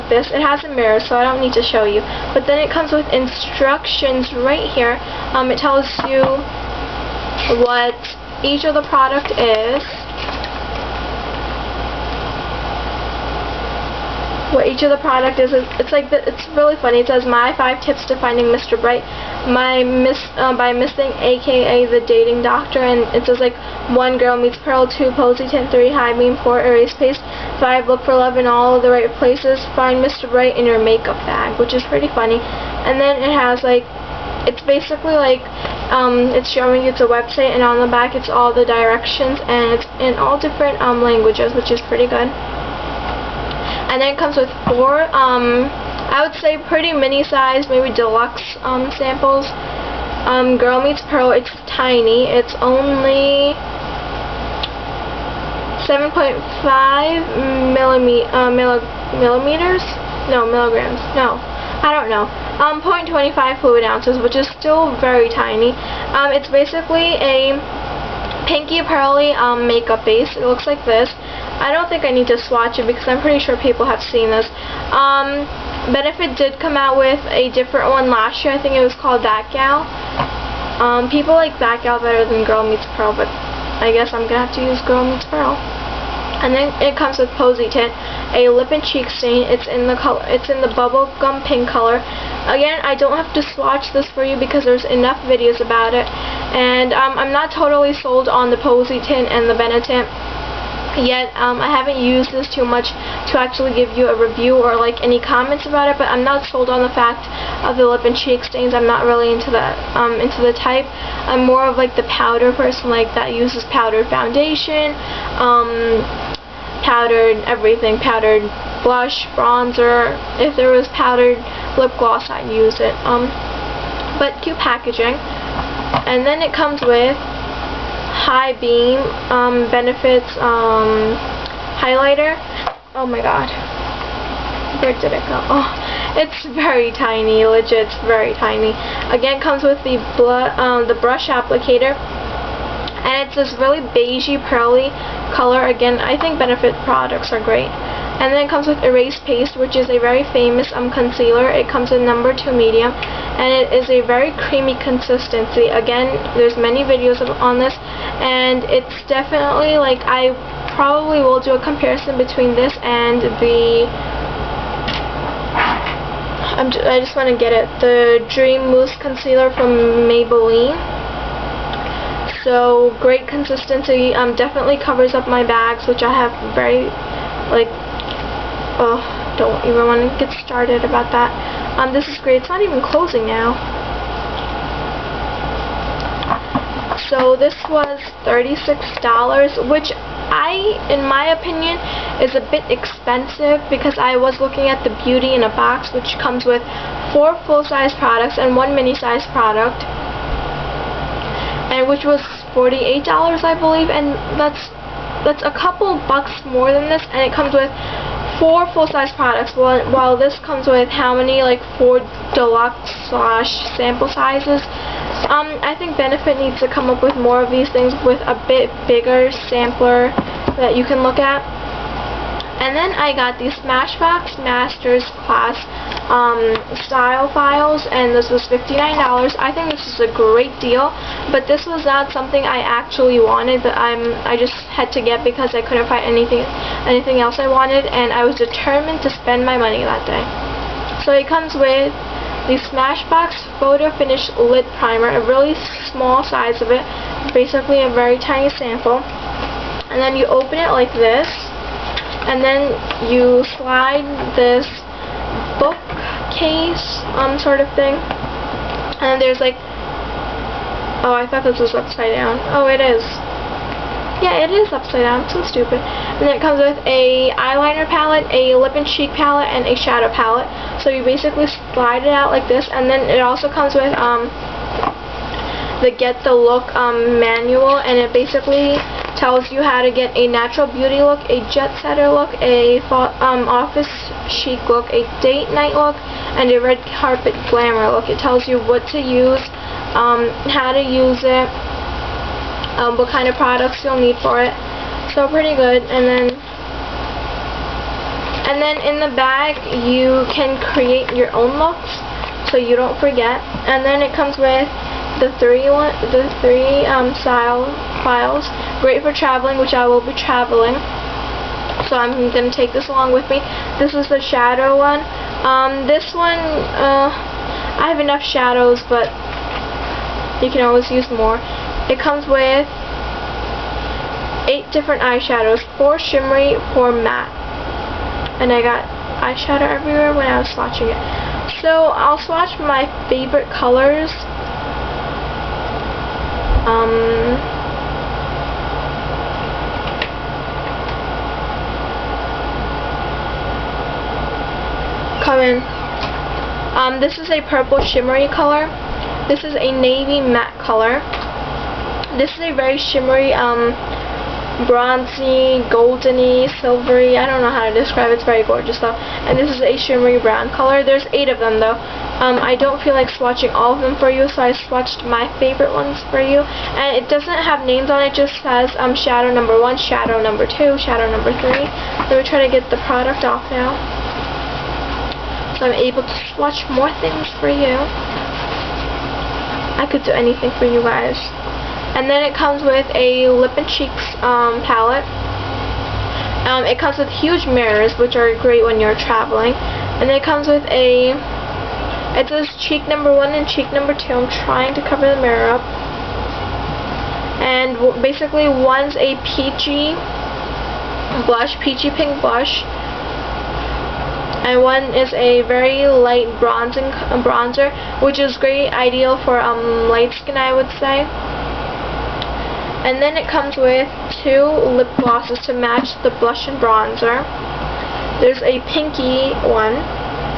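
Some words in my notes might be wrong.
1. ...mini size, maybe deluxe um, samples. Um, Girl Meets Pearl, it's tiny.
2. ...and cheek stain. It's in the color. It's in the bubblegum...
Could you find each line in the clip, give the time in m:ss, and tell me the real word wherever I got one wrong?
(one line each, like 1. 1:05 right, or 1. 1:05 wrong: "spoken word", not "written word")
1. 0:46 right
2. 1:28 right.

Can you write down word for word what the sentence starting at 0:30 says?
Bright in your makeup bag, which is pretty funny.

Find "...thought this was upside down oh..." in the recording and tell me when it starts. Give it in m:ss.
4:21.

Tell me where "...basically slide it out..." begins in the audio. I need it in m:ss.
4:31.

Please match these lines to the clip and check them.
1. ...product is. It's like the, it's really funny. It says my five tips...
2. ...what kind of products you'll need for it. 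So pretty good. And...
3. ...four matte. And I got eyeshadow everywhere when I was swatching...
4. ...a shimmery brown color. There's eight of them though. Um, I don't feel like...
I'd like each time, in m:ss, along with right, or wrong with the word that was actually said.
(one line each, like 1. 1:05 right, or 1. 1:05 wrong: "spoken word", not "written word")
1. 0:15 right
2. 4:52 right
3. 5:26 right
4. 5:59 right.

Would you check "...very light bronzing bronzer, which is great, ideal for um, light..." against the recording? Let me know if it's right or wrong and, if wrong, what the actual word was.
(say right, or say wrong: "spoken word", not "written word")
right.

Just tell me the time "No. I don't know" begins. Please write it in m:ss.
1:01.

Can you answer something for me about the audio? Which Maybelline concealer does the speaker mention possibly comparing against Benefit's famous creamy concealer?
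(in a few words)
Dream Mousse Concealer.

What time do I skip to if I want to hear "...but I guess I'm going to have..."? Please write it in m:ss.
1:23.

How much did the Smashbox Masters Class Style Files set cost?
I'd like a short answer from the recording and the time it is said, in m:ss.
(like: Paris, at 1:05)
$59, at 3:48.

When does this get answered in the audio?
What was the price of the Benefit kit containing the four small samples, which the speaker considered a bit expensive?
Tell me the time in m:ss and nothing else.
3:08.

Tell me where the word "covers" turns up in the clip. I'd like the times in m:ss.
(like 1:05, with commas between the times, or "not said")
2:54, 6:34.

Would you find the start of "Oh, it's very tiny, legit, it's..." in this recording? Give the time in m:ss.
2:15.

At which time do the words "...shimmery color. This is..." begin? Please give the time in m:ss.
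5:47.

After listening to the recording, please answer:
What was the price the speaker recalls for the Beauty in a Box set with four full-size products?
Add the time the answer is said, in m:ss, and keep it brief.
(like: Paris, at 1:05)
$48, at 3:22.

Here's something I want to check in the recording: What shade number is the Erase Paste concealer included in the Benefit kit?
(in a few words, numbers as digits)
number 2 medium.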